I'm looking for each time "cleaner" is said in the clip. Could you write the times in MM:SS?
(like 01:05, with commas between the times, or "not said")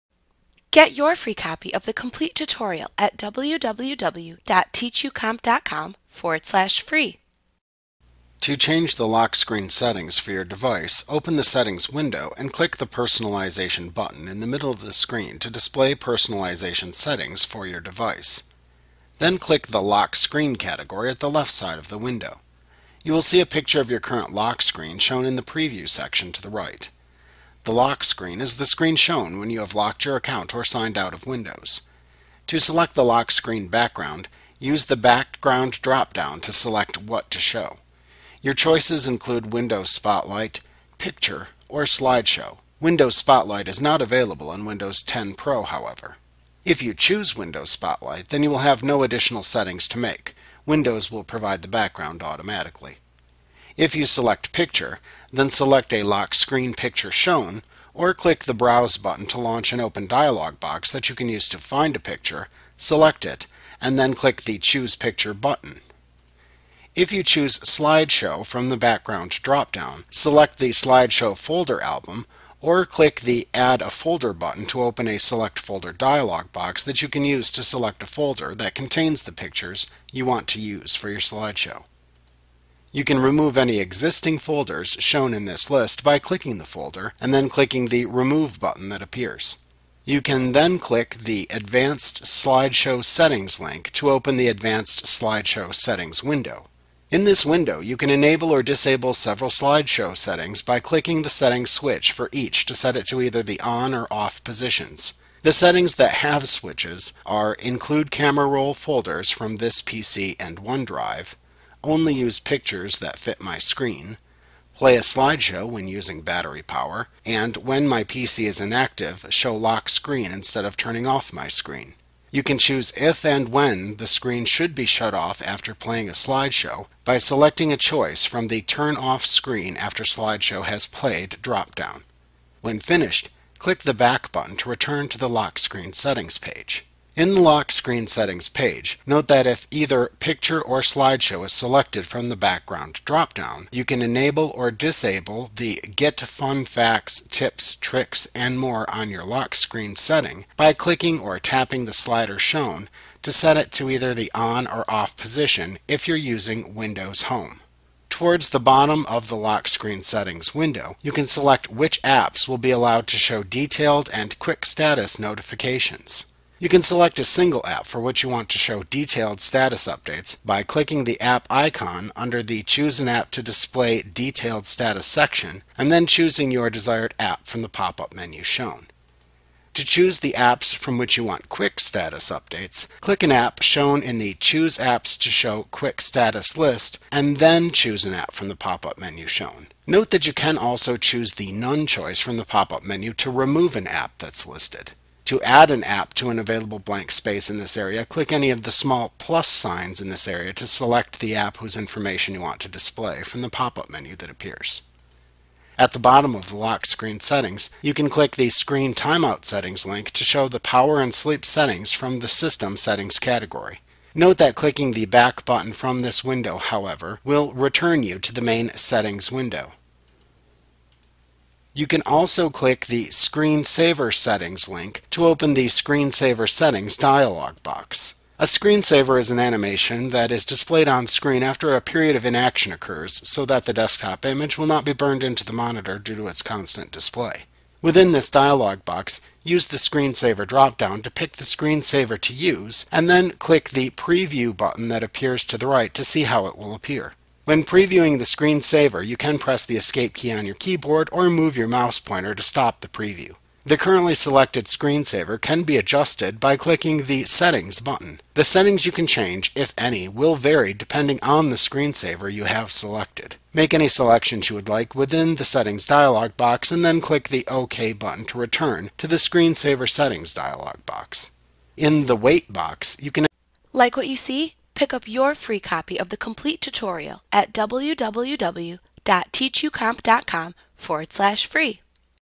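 not said.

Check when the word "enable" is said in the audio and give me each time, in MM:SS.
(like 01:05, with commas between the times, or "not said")
01:38, 02:24.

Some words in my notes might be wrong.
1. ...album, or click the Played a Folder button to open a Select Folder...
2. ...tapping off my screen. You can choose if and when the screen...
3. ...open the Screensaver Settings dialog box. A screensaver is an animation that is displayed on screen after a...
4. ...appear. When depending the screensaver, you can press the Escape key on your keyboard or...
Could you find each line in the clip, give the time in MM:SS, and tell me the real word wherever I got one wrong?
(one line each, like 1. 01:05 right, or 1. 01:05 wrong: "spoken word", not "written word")
1. 01:11 wrong: "Add", not "Played"
2. 02:00 wrong: "turning", not "tapping"
3. 03:45 right
4. 04:06 wrong: "previewing", not "depending".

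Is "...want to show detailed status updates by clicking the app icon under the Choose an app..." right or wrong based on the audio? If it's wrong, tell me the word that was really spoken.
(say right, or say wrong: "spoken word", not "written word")
right.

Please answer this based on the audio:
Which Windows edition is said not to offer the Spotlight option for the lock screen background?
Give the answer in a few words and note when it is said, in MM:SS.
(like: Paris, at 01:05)
Windows 10 Pro, at 00:44.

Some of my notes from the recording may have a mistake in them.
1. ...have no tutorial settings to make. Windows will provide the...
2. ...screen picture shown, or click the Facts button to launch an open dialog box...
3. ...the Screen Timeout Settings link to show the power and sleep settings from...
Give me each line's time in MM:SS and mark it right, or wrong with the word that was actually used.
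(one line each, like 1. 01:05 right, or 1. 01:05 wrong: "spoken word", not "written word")
1. 00:48 wrong: "additional", not "tutorial"
2. 00:56 wrong: "Browse", not "Facts"
3. 03:28 right.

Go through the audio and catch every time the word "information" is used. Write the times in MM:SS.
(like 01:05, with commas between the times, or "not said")
03:21.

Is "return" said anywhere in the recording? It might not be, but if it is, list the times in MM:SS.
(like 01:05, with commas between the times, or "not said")
02:14, 03:37, 04:28.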